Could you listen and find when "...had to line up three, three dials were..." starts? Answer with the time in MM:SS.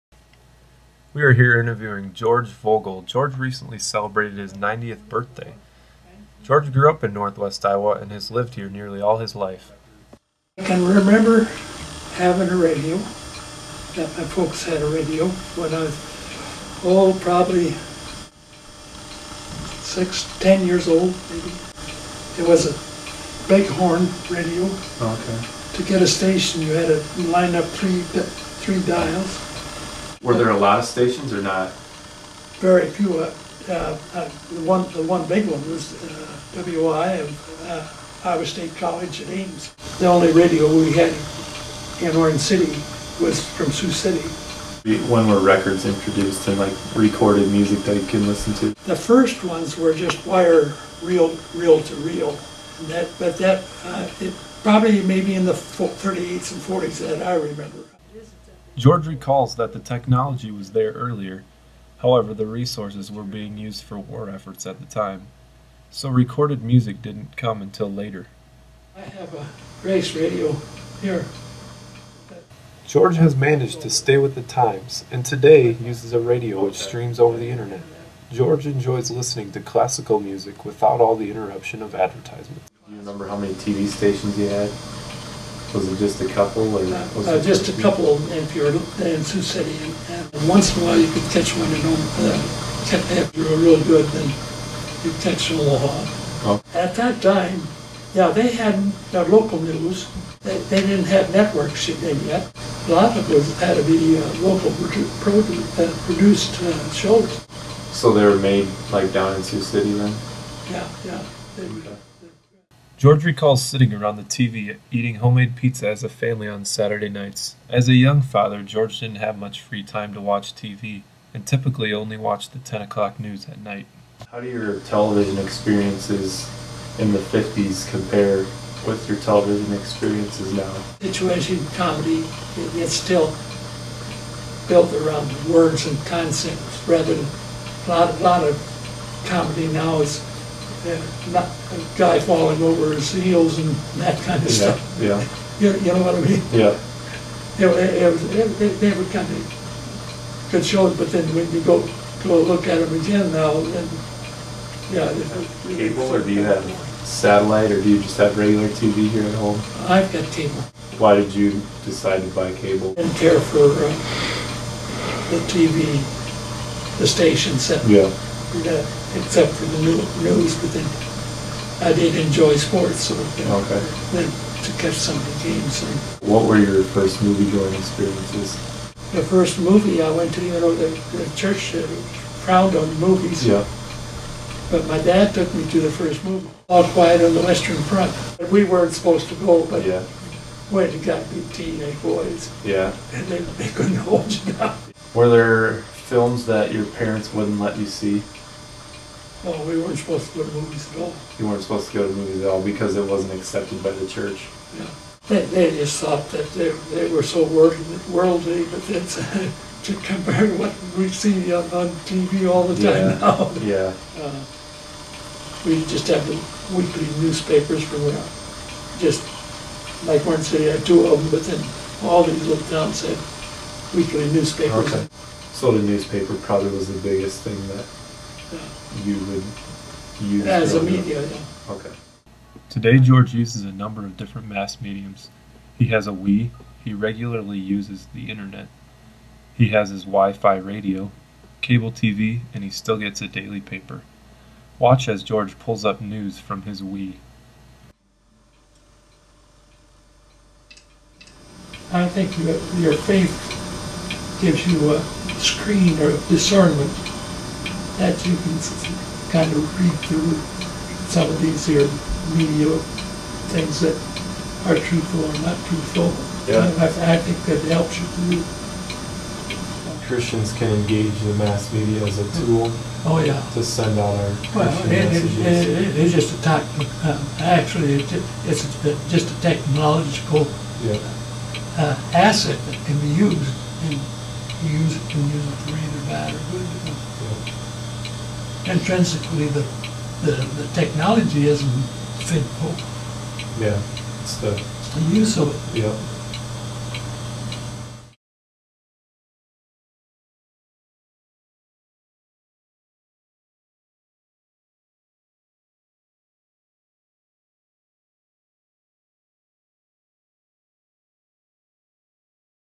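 00:26.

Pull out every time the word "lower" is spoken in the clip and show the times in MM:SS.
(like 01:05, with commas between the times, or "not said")
not said.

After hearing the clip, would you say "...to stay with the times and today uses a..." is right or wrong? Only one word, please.
right.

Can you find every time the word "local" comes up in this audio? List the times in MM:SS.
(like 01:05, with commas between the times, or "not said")
01:39, 01:44.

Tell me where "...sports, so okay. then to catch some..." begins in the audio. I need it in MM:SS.
02:52.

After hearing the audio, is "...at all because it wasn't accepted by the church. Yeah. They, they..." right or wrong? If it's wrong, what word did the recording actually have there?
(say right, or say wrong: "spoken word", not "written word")
right.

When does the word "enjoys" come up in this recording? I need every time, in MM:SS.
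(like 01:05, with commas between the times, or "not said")
01:18, 02:52.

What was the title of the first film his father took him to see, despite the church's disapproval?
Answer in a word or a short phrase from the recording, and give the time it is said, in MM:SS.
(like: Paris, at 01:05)
All Quiet on the Western Front, at 03:06.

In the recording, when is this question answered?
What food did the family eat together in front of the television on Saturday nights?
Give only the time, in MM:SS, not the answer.
01:55.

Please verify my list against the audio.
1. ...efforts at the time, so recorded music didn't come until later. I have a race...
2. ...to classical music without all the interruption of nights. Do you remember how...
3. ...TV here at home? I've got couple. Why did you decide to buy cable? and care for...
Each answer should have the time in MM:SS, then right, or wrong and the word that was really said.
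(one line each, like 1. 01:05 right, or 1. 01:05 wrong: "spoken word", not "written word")
1. 01:04 right
2. 01:19 wrong: "advertisements", not "nights"
3. 02:38 wrong: "cable", not "couple".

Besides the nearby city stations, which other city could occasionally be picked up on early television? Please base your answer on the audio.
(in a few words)
Omaha.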